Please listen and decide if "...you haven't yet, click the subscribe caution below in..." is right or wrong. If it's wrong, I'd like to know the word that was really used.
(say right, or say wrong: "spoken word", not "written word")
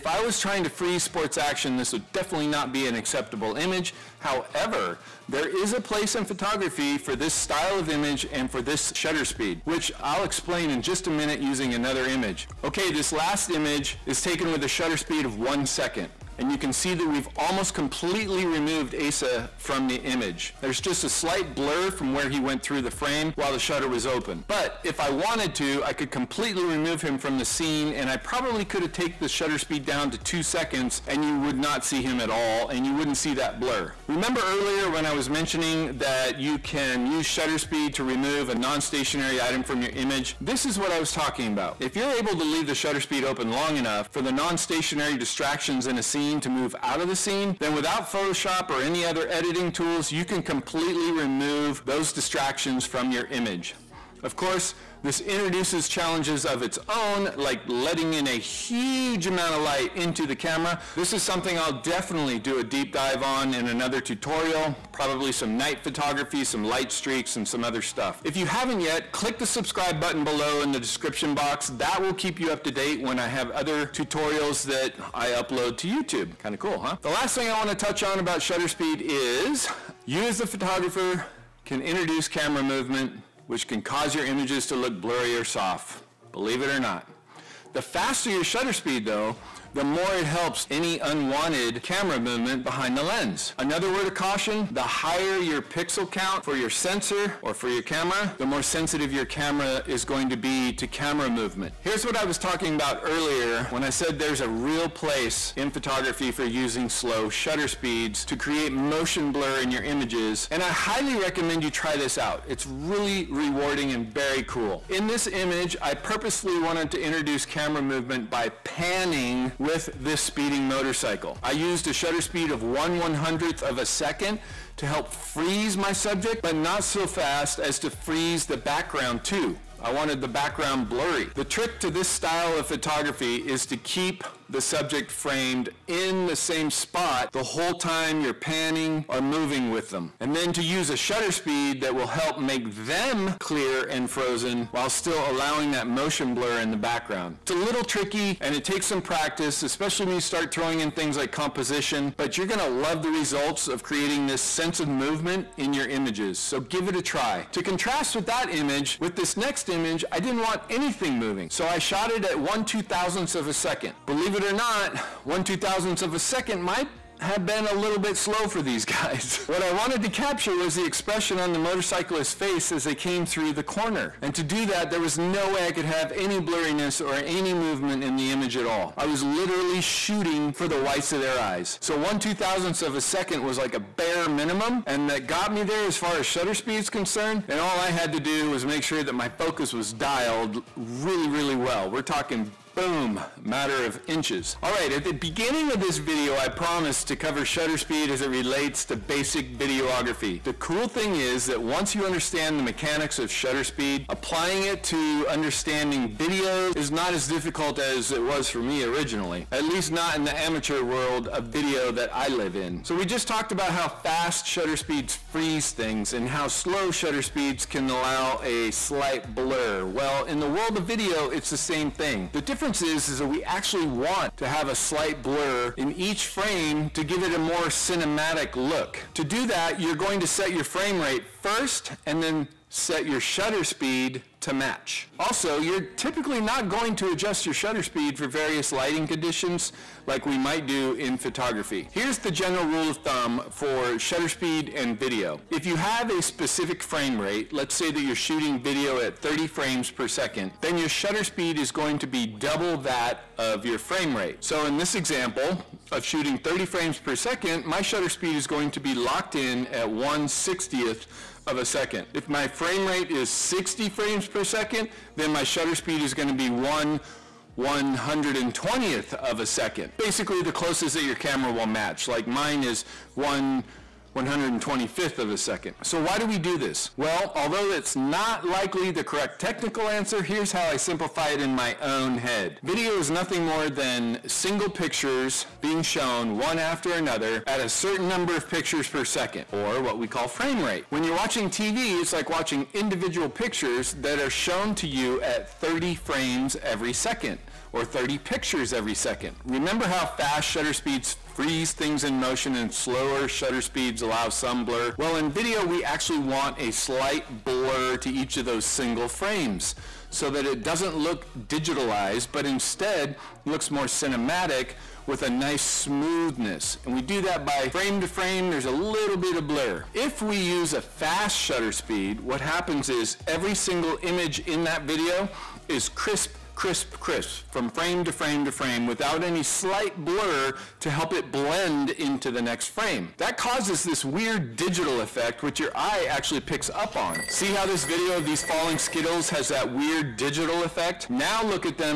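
wrong: "button", not "caution".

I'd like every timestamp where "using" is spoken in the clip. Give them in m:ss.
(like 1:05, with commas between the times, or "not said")
0:11, 1:46.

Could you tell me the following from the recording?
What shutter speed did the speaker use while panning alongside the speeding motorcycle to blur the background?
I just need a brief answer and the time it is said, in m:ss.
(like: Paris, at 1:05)
1/100th of a second, at 2:02.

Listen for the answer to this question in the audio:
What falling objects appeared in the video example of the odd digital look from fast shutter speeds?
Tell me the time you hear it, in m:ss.
5:38.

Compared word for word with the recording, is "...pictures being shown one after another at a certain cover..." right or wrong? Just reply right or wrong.
wrong.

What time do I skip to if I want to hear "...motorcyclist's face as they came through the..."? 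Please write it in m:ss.
2:51.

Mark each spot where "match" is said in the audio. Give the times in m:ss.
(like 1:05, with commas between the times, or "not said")
3:54, 4:31.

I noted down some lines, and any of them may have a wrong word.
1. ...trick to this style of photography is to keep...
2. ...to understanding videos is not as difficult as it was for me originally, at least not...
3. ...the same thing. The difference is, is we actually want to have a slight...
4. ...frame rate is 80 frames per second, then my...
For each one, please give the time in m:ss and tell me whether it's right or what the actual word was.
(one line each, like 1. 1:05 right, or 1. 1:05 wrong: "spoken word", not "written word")
1. 2:11 right
2. 3:24 right
3. 3:41 right
4. 4:22 wrong: "60", not "80".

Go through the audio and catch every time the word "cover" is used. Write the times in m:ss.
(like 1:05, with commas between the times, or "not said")
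3:17.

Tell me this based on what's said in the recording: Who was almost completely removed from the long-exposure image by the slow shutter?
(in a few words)
Asa.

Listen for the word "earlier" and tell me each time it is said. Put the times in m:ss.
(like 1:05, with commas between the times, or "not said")
0:34, 1:43.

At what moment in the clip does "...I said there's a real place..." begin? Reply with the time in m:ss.
1:43.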